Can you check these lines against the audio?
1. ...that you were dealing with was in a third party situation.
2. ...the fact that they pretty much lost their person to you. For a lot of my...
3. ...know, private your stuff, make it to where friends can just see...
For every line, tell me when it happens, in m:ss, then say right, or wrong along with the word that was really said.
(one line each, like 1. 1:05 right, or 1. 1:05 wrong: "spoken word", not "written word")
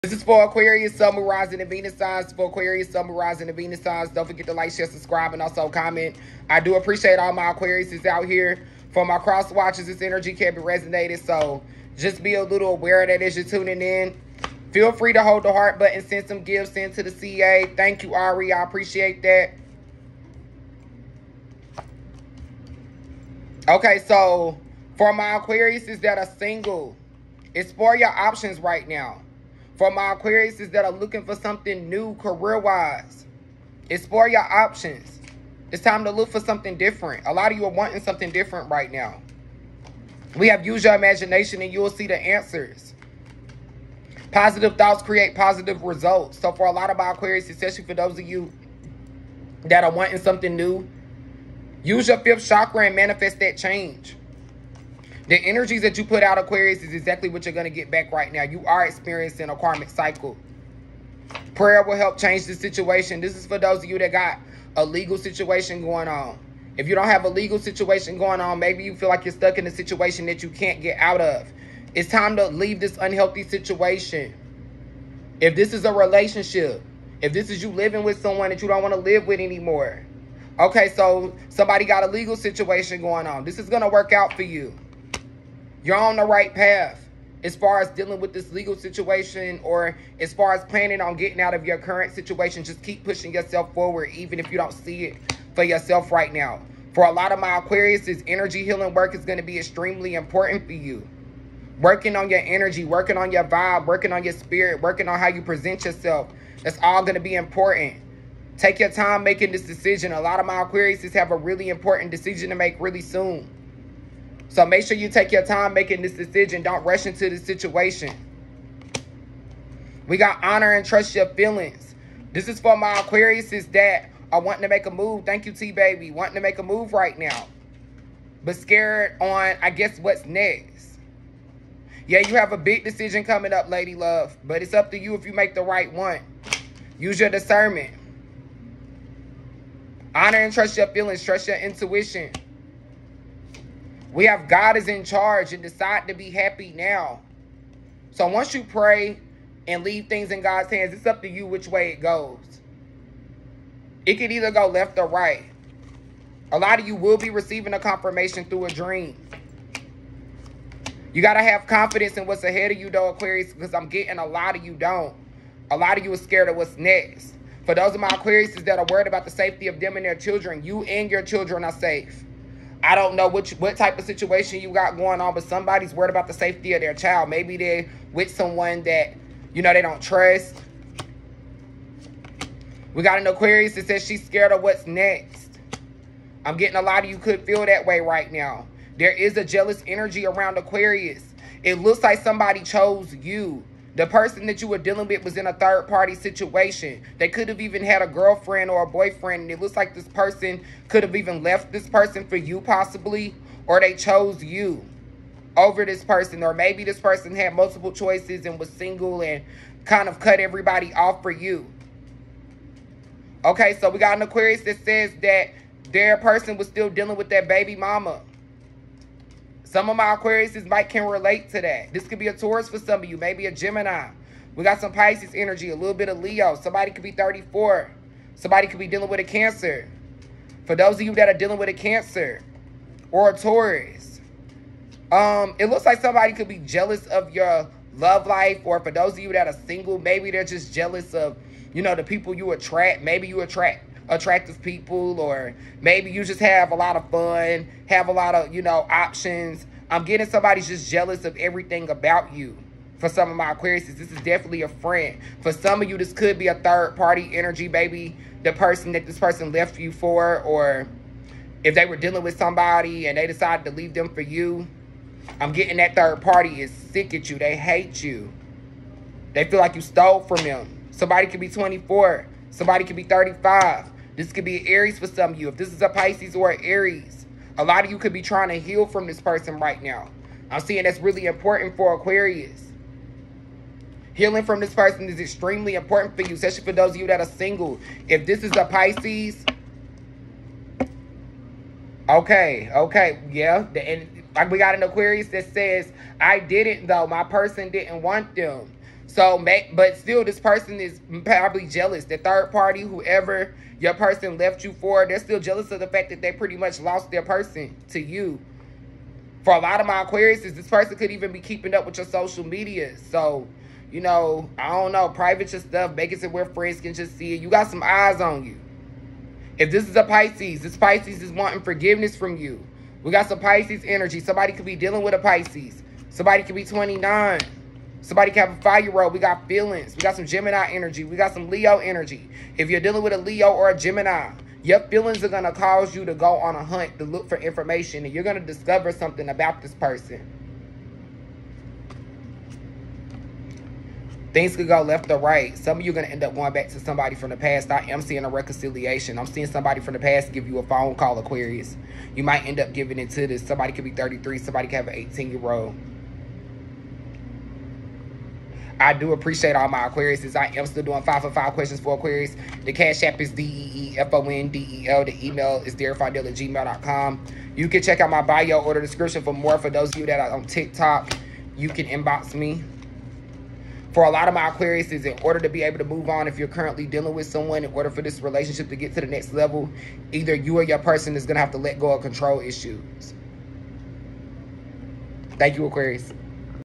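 1. 3:14 right
2. 5:05 right
3. 5:14 right.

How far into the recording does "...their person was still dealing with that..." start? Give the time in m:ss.
3:35.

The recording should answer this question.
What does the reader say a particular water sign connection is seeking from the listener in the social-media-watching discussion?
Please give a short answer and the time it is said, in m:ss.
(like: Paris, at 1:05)
forgiveness, at 5:21.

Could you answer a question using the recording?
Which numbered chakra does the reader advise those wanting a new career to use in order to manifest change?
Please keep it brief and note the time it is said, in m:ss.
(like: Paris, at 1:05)
fifth chakra, at 0:52.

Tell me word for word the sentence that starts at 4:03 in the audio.
Maybe you attract attractive people or maybe you just have a lot of fun, have a lot of, you know, options.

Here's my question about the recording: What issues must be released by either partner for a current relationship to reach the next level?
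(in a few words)
control issues.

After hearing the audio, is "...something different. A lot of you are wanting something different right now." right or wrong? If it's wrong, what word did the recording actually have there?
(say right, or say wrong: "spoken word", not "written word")
right.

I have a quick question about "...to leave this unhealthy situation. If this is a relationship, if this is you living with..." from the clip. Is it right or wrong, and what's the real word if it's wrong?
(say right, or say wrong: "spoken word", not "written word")
right.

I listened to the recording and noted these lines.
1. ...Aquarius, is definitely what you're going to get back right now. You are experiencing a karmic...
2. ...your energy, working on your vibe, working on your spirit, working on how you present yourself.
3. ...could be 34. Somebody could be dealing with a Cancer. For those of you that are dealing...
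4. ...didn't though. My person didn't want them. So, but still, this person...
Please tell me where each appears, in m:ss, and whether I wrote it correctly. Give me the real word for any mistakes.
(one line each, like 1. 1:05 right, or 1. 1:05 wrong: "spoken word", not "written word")
1. 0:56 wrong: "exactly", not "definitely"
2. 1:42 right
3. 3:46 right
4. 4:56 right.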